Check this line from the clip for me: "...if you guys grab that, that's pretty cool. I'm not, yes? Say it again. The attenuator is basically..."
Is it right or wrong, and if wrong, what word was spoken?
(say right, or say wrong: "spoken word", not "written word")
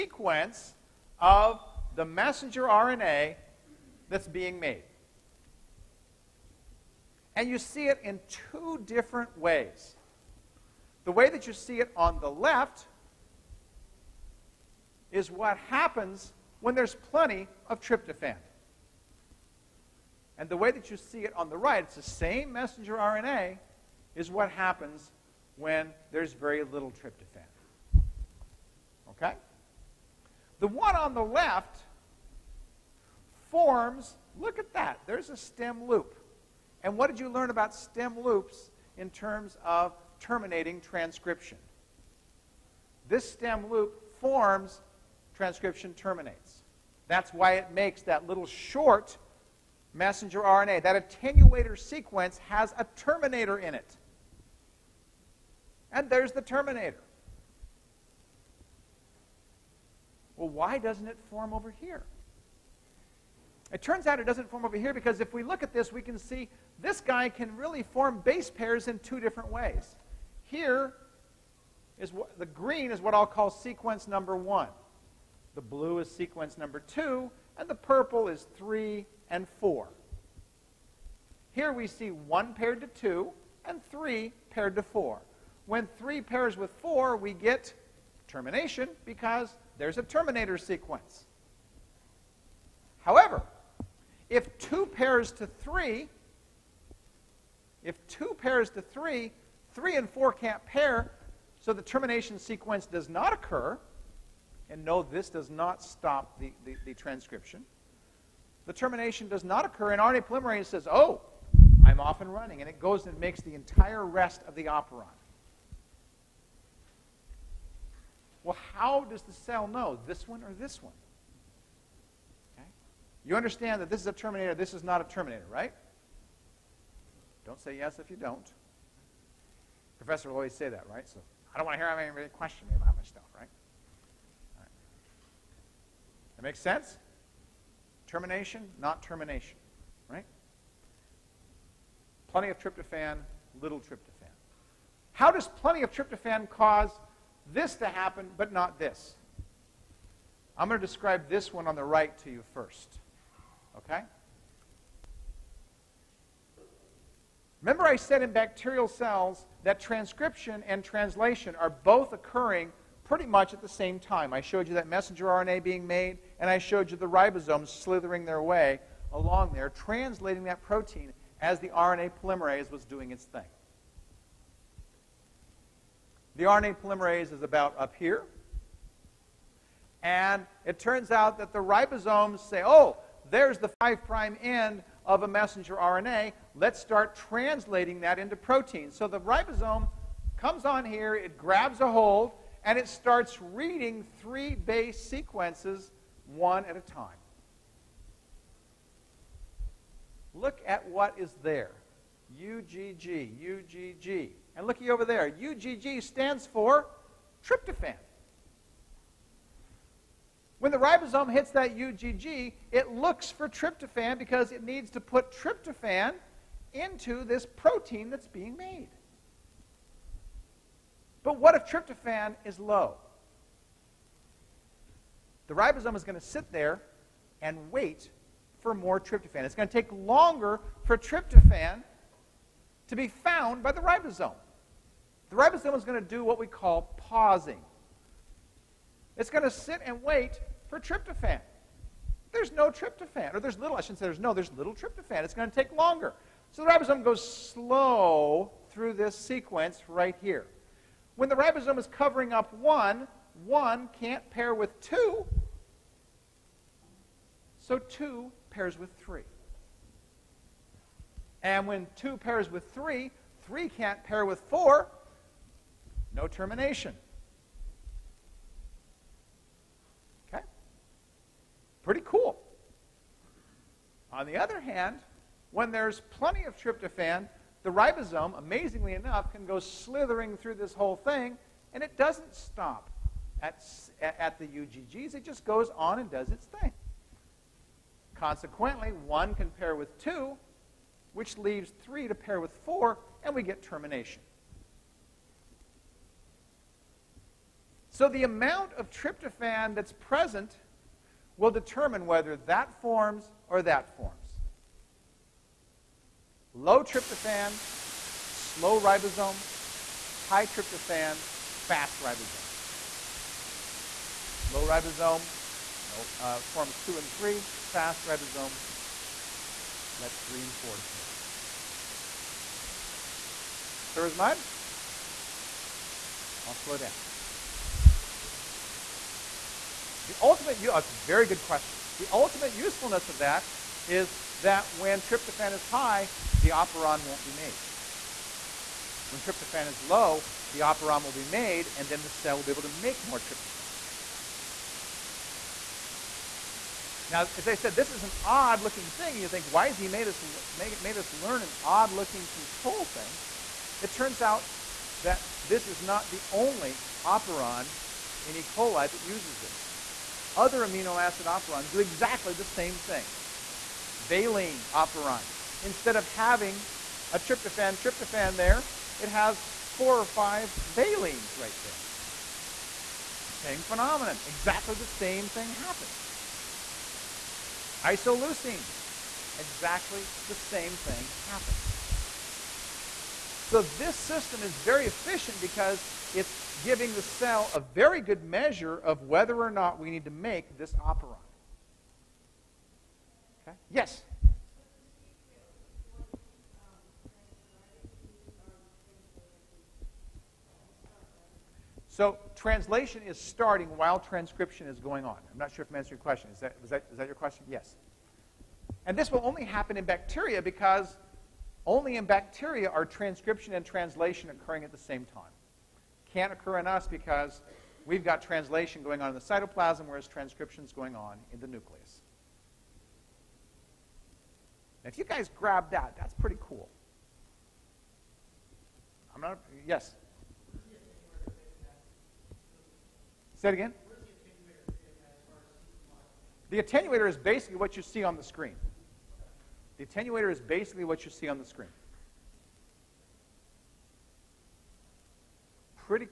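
right.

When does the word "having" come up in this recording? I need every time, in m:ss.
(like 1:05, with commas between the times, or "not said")
6:06.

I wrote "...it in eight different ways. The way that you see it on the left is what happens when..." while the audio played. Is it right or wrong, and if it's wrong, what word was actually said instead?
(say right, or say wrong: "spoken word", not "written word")
wrong: "two", not "eight".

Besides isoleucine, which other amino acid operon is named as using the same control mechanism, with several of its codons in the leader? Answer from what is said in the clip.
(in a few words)
Valine.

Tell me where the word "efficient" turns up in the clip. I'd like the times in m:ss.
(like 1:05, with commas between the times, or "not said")
6:24.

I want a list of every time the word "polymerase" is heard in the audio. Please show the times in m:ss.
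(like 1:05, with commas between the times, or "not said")
1:50, 2:52, 2:56.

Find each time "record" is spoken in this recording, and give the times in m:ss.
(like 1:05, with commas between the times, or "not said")
not said.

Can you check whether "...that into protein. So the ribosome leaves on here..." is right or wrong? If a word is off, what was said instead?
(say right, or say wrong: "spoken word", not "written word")
wrong: "comes", not "leaves".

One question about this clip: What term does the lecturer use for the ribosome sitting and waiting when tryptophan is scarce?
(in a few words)
Pausing.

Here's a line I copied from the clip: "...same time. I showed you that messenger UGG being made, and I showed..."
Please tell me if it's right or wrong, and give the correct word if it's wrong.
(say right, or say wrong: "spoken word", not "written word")
wrong: "RNA", not "UGG".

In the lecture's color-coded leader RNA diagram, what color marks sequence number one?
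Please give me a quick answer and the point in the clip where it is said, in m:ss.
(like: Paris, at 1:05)
Green, at 1:12.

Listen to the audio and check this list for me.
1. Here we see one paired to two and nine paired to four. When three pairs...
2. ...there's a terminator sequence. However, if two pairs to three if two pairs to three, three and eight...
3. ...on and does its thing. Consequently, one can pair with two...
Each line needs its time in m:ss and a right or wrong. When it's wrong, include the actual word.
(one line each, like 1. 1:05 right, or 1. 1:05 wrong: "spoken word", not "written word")
1. 1:21 wrong: "three", not "nine"
2. 1:29 wrong: "four", not "eight"
3. 4:45 right.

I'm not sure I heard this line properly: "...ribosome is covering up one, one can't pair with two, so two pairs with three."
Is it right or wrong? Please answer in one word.
right.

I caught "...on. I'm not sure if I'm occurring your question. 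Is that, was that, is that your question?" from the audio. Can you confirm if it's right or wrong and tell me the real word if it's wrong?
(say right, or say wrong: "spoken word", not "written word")
wrong: "answering", not "occurring".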